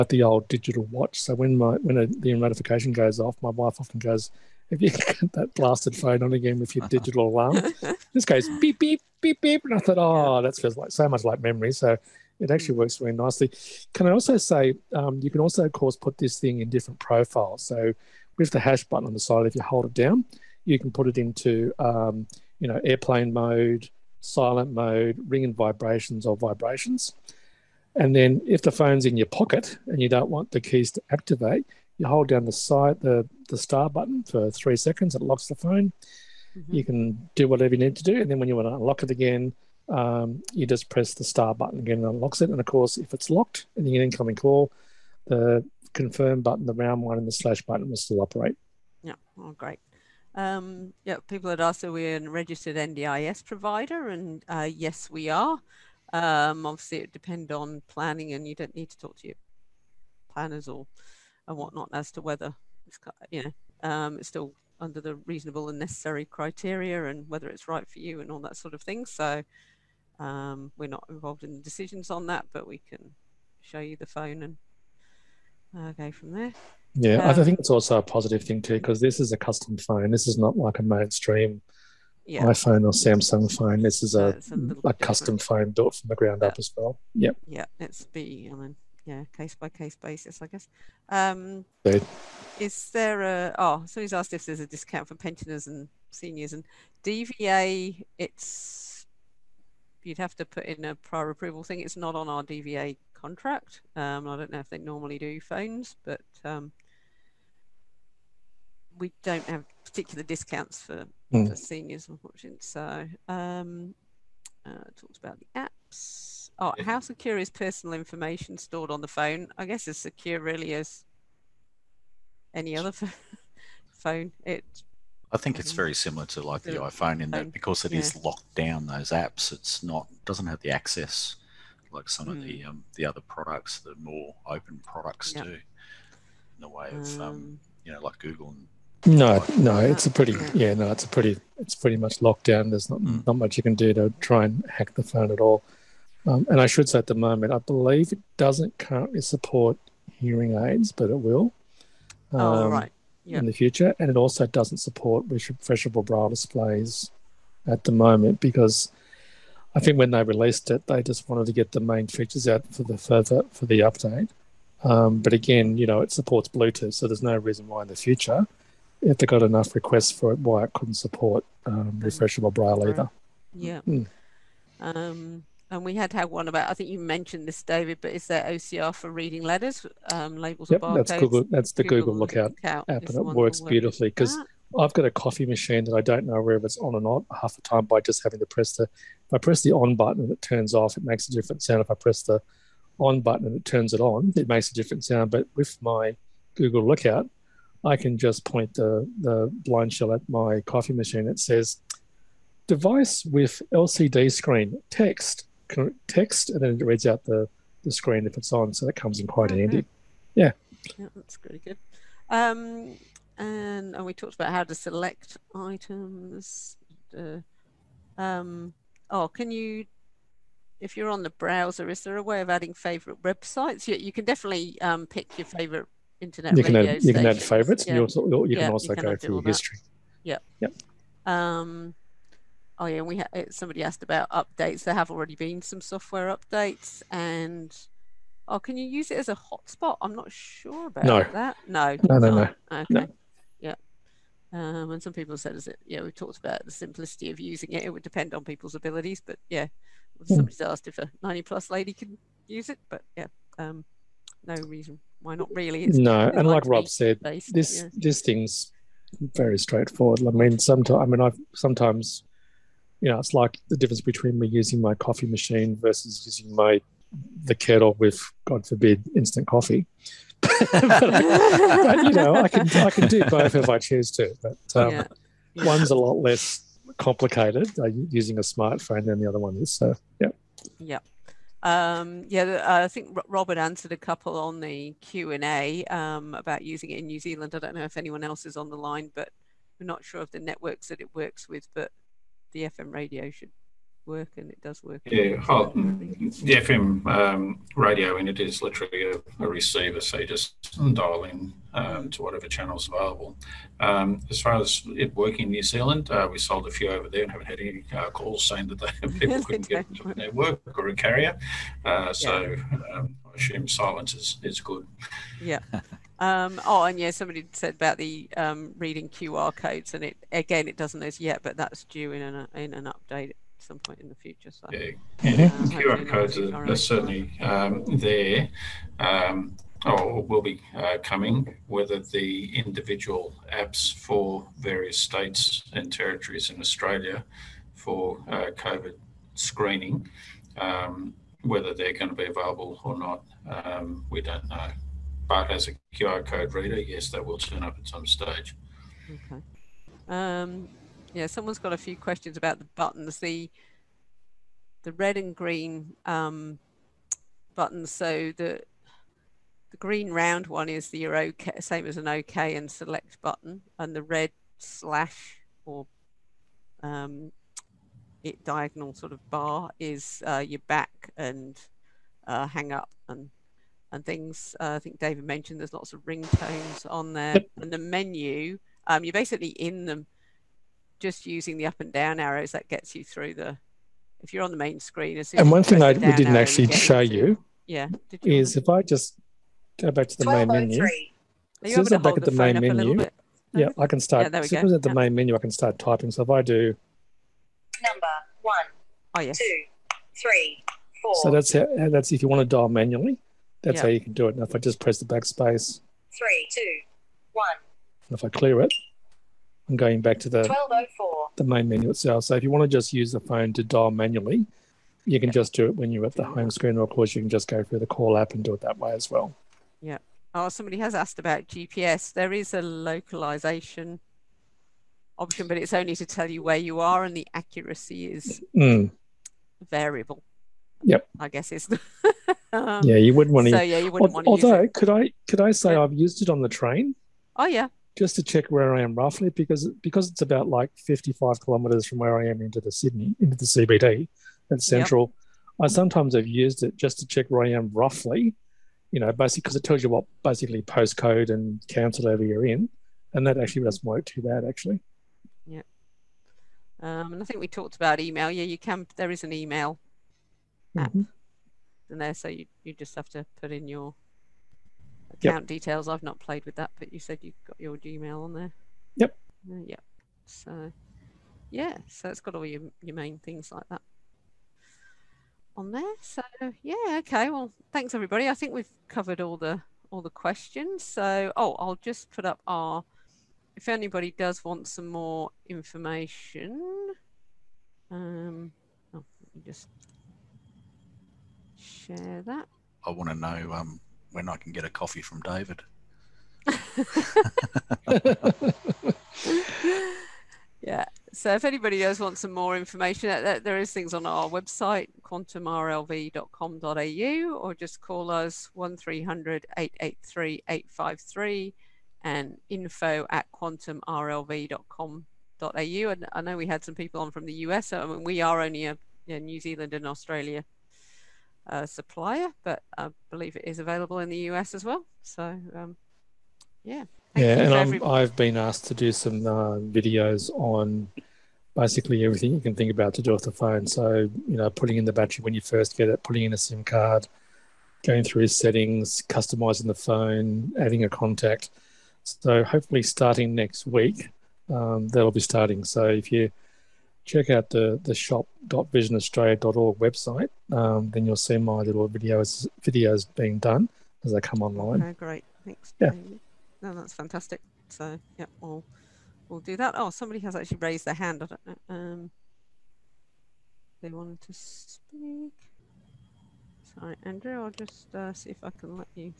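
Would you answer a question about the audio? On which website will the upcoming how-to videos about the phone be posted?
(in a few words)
shop.visionaustralia.org.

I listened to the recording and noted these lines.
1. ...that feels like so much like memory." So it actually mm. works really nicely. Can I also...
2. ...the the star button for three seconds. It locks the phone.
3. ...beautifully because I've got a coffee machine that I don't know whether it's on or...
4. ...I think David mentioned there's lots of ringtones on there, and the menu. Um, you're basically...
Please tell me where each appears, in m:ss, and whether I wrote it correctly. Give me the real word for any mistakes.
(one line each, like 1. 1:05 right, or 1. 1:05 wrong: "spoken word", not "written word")
1. 0:10 right
2. 0:33 right
3. 3:03 right
4. 6:14 right.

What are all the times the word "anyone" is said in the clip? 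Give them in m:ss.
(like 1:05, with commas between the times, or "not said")
4:47.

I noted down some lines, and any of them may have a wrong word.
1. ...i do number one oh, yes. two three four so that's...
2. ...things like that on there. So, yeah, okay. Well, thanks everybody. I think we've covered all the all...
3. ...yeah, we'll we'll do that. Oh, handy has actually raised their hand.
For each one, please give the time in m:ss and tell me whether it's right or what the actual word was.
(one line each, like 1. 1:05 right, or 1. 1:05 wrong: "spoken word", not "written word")
1. 6:36 right
2. 7:53 right
3. 9:18 wrong: "somebody", not "handy".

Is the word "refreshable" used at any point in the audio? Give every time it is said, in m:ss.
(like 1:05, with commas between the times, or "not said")
2:35, 2:51.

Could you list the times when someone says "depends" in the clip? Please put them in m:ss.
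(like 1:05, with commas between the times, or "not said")
0:57, 4:08.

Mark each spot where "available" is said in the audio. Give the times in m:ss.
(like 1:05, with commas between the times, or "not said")
5:02, 5:42, 8:43.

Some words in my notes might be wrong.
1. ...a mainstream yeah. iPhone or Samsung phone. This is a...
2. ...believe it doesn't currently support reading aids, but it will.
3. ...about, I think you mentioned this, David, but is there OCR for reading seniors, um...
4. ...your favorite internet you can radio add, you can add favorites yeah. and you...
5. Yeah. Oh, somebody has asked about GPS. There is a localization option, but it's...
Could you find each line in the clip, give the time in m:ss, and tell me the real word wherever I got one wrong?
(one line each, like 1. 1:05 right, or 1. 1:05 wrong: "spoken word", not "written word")
1. 1:20 right
2. 2:27 wrong: "hearing", not "reading"
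3. 2:56 wrong: "letters", not "seniors"
4. 3:45 right
5. 6:59 right.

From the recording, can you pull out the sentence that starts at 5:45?
But as a QR code reader, yes, that will turn up at some stage.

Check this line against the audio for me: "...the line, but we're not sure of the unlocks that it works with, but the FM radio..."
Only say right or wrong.
wrong.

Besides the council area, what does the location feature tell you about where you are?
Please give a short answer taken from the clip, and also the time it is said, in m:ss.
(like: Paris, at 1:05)
postcode, at 7:30.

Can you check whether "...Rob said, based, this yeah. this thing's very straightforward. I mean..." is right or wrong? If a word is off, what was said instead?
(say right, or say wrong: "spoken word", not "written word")
right.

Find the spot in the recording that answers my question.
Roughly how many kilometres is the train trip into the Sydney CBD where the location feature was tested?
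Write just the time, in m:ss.
7:20.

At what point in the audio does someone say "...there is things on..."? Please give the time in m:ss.
8:23.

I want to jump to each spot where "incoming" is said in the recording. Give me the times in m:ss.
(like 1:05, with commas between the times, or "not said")
0:44.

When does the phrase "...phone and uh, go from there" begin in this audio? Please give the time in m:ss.
1:14.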